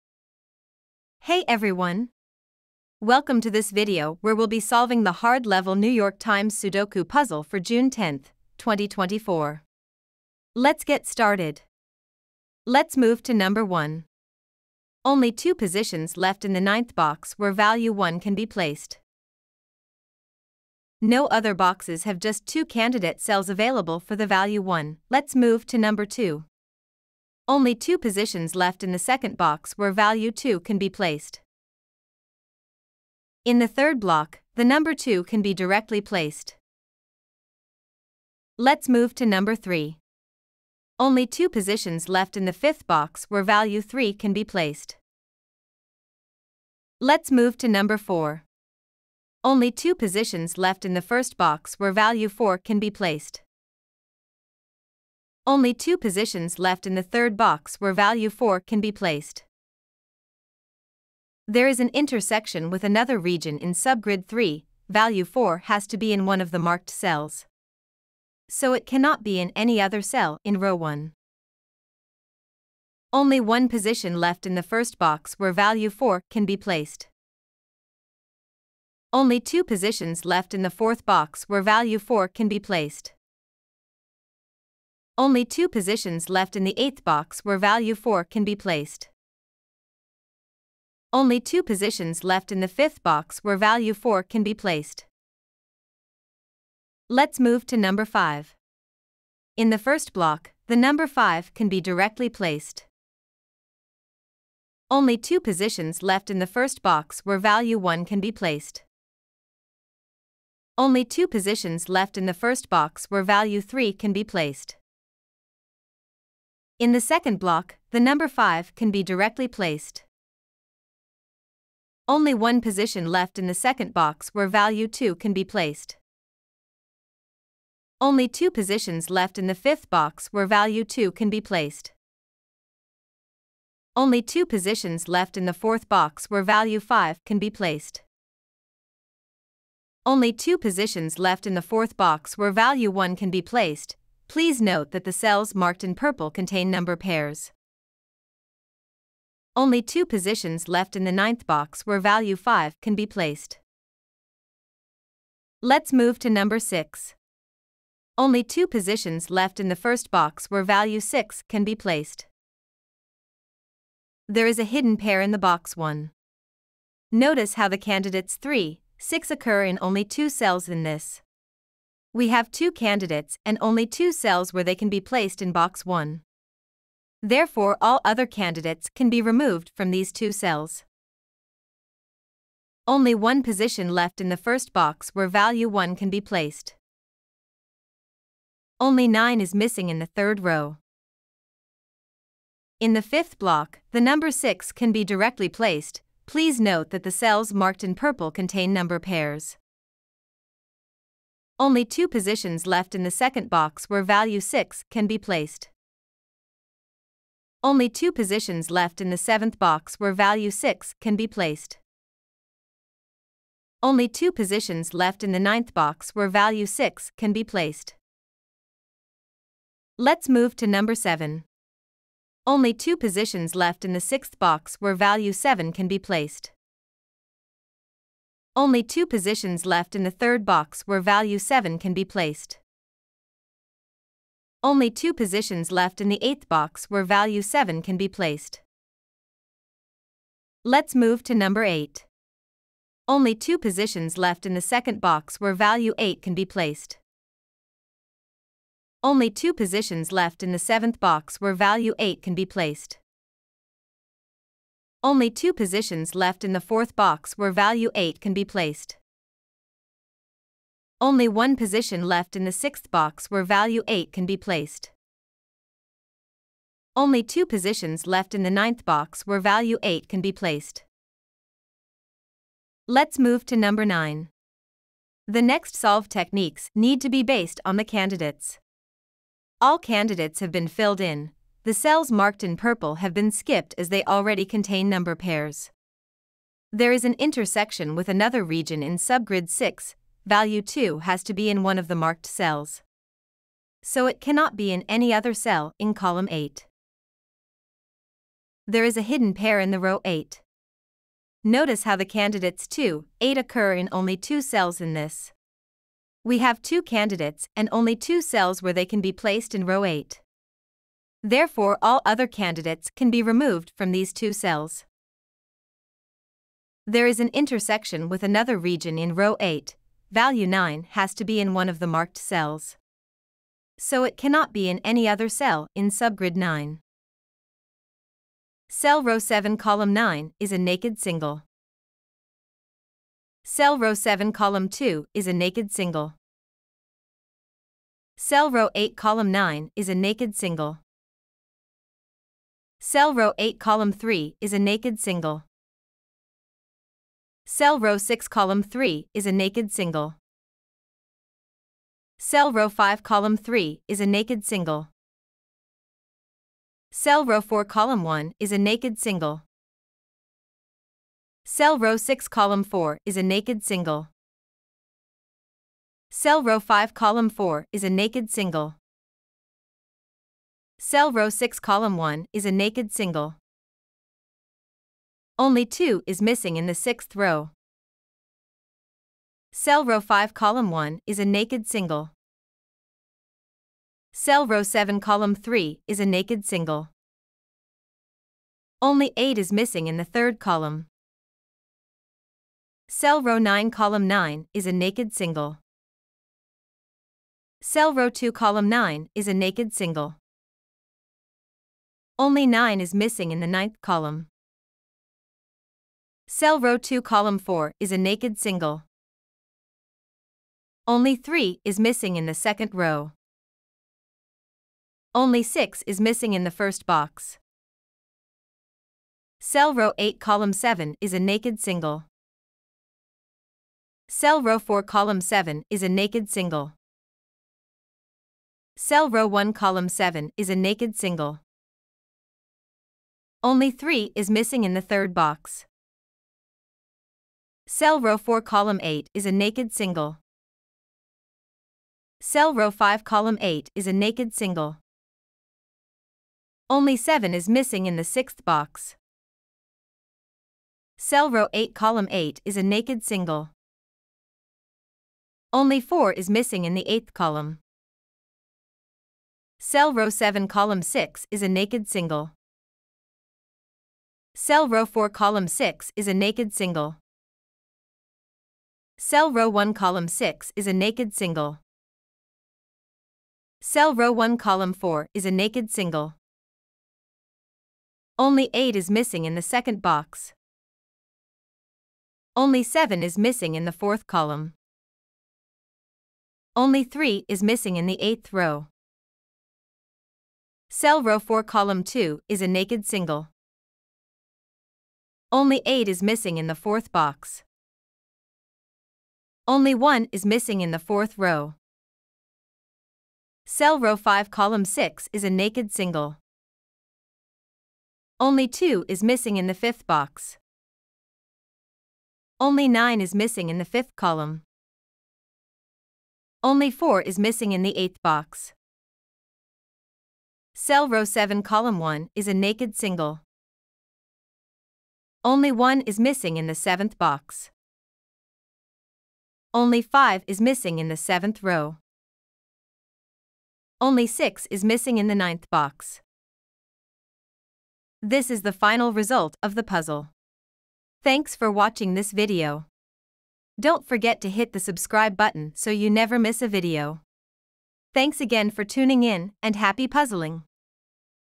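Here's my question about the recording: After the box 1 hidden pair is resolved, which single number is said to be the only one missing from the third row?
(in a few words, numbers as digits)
9.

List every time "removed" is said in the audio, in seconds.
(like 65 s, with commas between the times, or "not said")
179 s, 313 s.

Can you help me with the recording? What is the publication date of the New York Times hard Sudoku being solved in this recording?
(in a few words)
June 10, 2024.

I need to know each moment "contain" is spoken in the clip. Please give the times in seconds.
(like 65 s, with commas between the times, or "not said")
146 s, 198 s, 284 s.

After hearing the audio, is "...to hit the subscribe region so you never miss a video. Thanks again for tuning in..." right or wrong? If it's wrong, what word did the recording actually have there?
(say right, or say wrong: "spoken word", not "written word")
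wrong: "button", not "region".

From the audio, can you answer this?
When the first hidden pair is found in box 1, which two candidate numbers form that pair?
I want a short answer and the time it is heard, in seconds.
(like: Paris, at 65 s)
3, 6, at 168 s.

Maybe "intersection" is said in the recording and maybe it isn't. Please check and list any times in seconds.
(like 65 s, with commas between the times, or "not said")
61 s, 287 s, 317 s.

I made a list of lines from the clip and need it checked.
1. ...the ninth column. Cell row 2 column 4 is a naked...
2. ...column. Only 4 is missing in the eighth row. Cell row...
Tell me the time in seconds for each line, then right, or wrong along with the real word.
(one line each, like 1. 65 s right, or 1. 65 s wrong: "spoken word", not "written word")
1. 403 s right
2. 484 s wrong: "3", not "4".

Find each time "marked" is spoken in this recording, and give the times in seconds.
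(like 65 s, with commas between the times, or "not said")
66 s, 145 s, 197 s, 282 s, 291 s, 321 s.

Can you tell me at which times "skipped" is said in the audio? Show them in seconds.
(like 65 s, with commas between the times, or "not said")
283 s.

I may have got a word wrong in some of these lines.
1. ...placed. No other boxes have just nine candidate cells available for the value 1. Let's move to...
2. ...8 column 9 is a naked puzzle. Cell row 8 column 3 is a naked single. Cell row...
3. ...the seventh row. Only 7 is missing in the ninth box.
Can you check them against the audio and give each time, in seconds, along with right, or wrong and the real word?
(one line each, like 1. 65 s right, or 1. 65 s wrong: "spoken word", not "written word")
1. 18 s wrong: "two", not "nine"
2. 338 s wrong: "single", not "puzzle"
3. 530 s wrong: "6", not "7".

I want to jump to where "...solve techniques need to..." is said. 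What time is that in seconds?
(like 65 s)
275 s.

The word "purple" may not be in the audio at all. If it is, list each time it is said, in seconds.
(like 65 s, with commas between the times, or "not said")
145 s, 197 s, 282 s.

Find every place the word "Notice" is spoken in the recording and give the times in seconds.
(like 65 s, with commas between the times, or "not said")
167 s, 301 s.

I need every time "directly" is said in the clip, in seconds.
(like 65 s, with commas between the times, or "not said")
35 s, 101 s, 119 s, 195 s.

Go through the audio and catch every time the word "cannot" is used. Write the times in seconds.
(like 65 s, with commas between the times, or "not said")
68 s, 294 s, 324 s.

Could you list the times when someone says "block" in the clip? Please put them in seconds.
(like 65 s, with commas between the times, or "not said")
33 s, 100 s, 117 s, 193 s.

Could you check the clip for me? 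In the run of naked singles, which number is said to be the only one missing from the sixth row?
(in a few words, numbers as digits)
2.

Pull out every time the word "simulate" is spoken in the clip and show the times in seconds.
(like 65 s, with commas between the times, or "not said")
not said.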